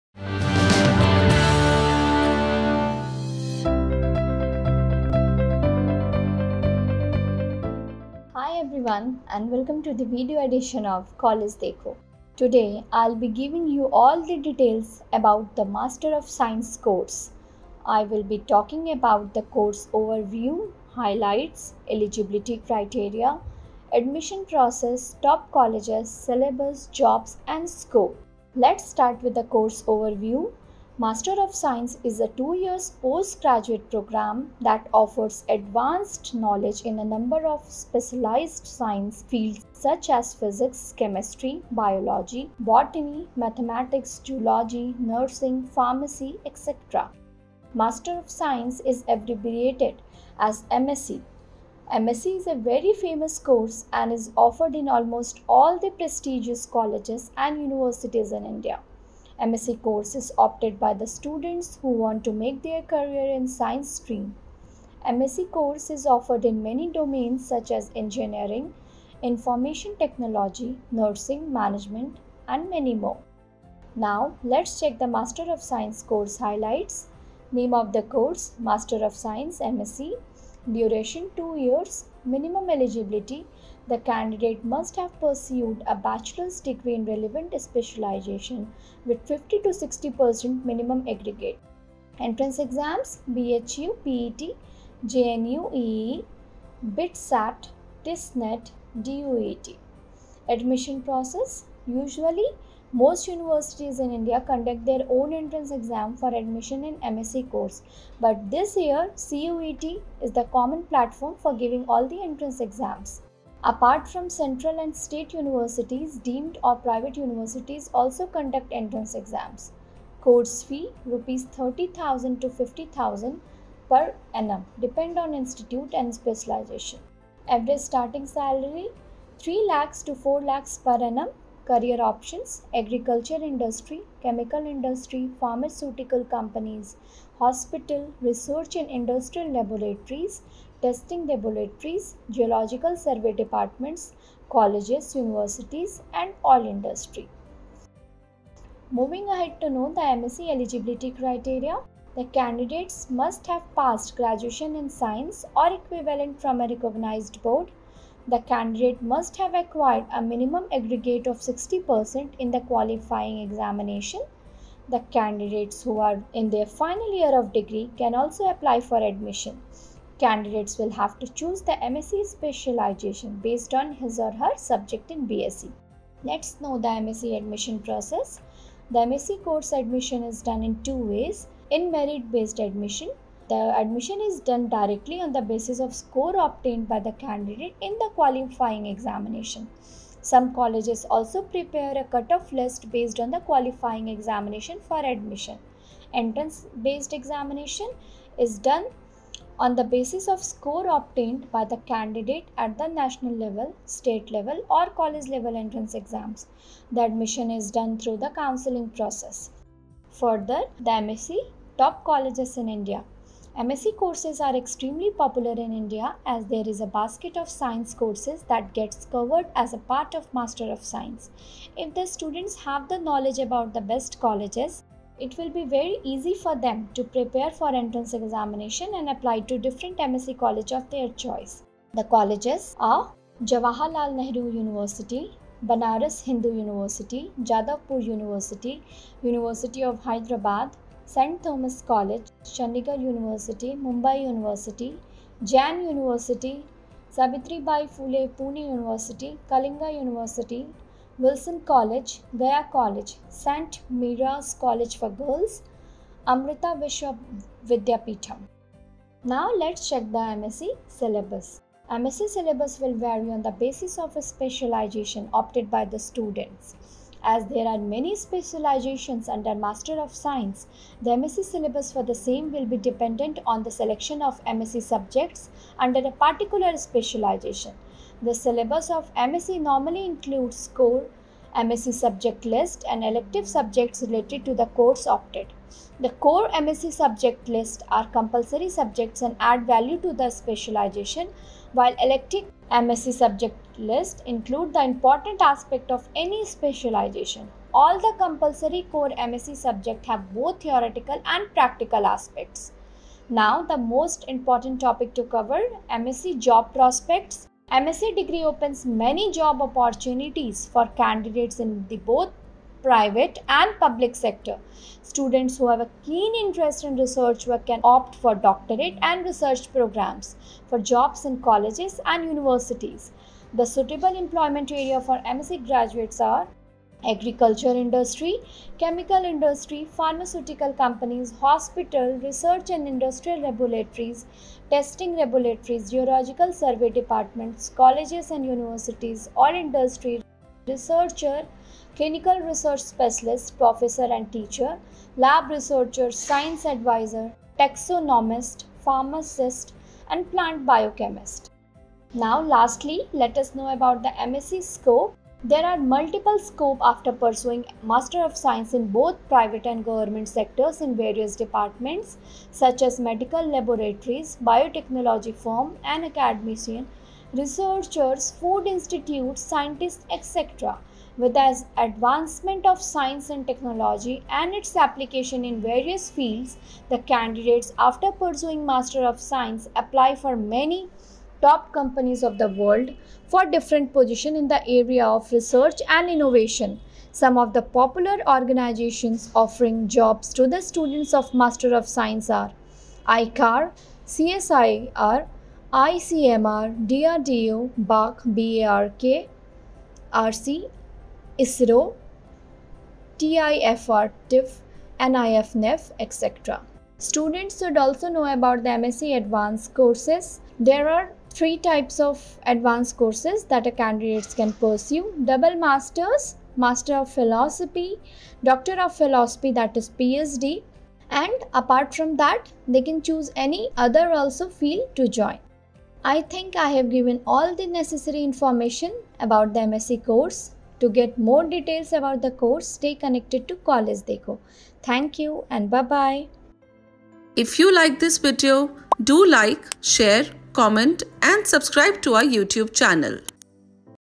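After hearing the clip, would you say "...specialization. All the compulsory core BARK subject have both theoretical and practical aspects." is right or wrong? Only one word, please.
wrong.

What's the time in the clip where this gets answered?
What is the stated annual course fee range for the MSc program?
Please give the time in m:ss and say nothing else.
2:01.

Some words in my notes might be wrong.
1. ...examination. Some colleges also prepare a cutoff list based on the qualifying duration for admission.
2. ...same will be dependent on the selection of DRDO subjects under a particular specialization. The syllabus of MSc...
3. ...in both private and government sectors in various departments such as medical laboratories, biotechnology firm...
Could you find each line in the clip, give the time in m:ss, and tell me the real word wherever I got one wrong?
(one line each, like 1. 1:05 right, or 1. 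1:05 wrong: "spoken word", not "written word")
1. 3:08 wrong: "examination", not "duration"
2. 4:32 wrong: "MSc", not "DRDO"
3. 5:58 right.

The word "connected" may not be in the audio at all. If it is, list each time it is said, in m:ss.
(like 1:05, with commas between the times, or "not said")
7:12.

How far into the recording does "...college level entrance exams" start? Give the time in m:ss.
3:24.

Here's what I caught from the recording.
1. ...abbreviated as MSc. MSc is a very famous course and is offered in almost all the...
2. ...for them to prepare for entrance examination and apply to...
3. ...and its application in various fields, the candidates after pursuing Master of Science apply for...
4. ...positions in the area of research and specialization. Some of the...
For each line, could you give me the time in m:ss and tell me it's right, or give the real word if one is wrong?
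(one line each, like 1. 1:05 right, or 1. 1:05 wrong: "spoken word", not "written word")
1. 0:49 right
2. 3:46 right
3. 6:14 right
4. 6:23 wrong: "innovation", not "specialization".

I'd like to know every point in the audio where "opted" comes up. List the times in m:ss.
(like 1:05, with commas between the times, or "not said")
1:00, 4:25, 4:45.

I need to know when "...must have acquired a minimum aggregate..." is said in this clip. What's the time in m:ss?
2:39.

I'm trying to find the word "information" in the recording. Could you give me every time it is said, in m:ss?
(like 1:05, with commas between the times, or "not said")
1:09, 7:08.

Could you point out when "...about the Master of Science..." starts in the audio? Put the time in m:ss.
0:15.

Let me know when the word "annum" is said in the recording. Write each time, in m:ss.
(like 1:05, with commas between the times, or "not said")
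2:04, 2:11.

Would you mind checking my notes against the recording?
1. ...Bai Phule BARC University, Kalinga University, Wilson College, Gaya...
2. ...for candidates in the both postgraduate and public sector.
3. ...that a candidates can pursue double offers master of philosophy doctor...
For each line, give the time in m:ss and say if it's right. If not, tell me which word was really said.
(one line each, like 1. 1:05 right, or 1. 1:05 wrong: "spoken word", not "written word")
1. 4:07 wrong: "Pune", not "BARC"
2. 5:10 wrong: "private", not "postgraduate"
3. 6:53 wrong: "masters", not "offers".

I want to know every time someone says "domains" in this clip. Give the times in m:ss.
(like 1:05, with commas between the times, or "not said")
1:06.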